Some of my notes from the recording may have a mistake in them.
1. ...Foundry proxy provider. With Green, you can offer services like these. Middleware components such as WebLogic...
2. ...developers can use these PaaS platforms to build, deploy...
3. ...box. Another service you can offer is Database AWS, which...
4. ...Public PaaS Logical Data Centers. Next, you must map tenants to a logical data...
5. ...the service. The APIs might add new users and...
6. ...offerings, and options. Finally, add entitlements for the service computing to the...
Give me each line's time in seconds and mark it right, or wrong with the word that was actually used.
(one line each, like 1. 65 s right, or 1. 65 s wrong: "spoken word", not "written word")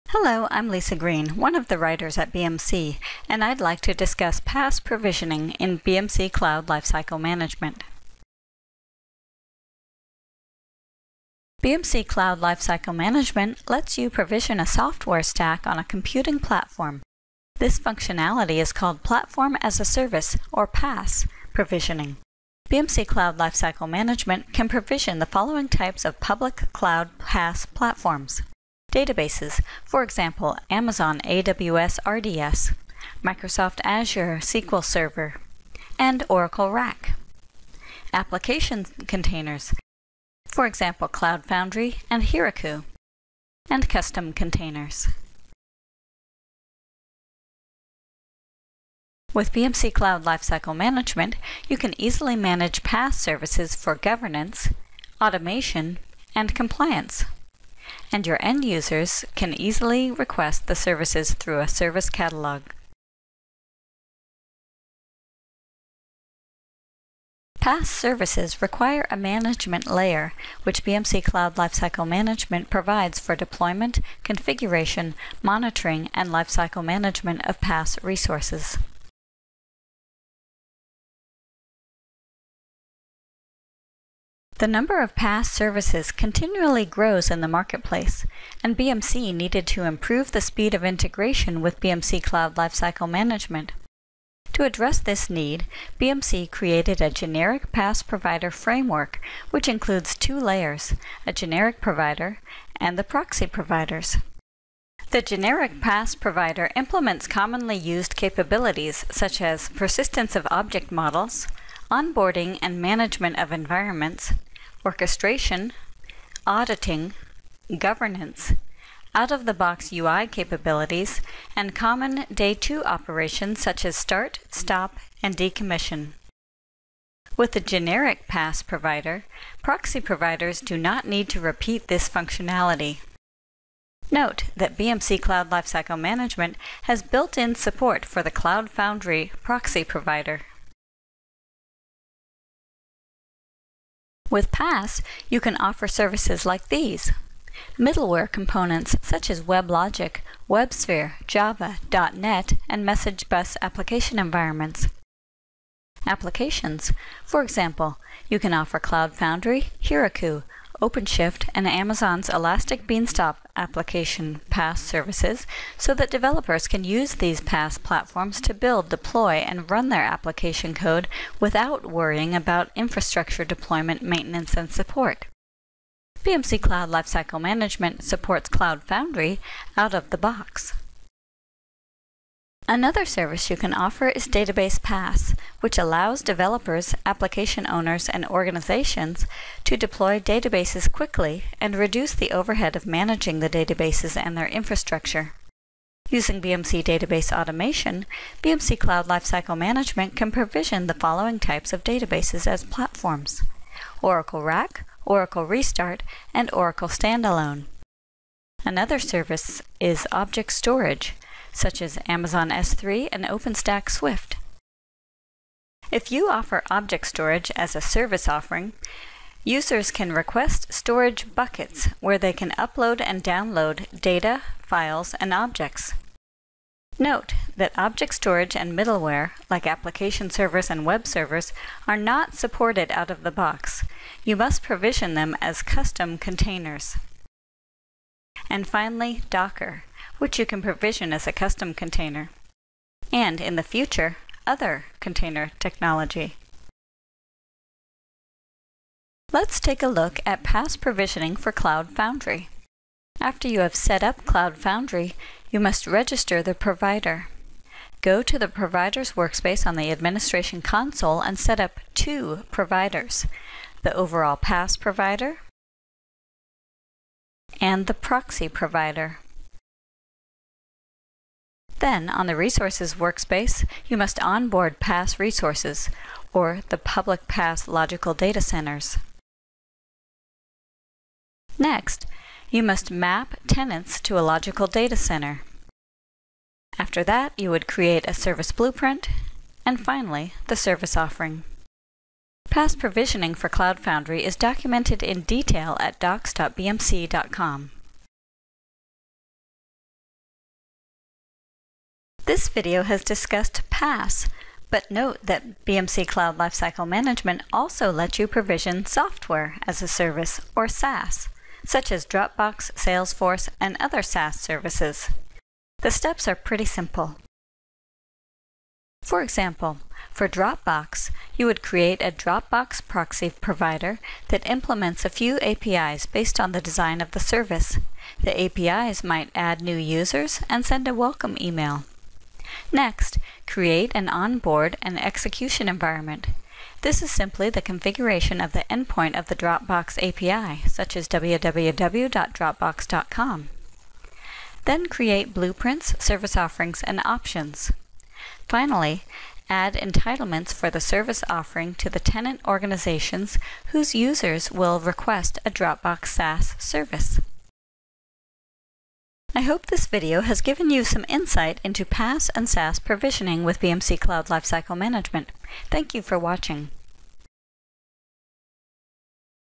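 1. 138 s wrong: "PaaS", not "Green"
2. 166 s right
3. 180 s wrong: "PaaS", not "AWS"
4. 276 s right
5. 327 s right
6. 346 s wrong: "offering", not "computing".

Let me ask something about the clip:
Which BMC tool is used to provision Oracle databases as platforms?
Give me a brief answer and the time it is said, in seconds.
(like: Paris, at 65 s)
BMC Database Automation, at 196 s.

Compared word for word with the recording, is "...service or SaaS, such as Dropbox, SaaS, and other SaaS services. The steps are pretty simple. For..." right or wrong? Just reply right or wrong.
wrong.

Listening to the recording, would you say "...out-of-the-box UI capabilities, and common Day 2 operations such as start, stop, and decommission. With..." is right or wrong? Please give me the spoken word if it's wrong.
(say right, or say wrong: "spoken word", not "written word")
right.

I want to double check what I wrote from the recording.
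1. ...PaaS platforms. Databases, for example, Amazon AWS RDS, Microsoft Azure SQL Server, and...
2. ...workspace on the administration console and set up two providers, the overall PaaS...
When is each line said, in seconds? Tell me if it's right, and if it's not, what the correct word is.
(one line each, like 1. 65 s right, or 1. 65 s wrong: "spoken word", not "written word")
1. 27 s right
2. 259 s right.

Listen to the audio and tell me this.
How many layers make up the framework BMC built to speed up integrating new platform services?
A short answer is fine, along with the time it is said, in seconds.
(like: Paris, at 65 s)
2, at 100 s.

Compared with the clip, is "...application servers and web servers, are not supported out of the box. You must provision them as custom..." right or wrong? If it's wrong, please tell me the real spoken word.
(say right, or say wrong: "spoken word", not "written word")
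right.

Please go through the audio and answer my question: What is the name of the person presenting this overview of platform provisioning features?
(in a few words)
Lisa Green.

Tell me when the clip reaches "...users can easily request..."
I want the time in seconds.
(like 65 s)
58 s.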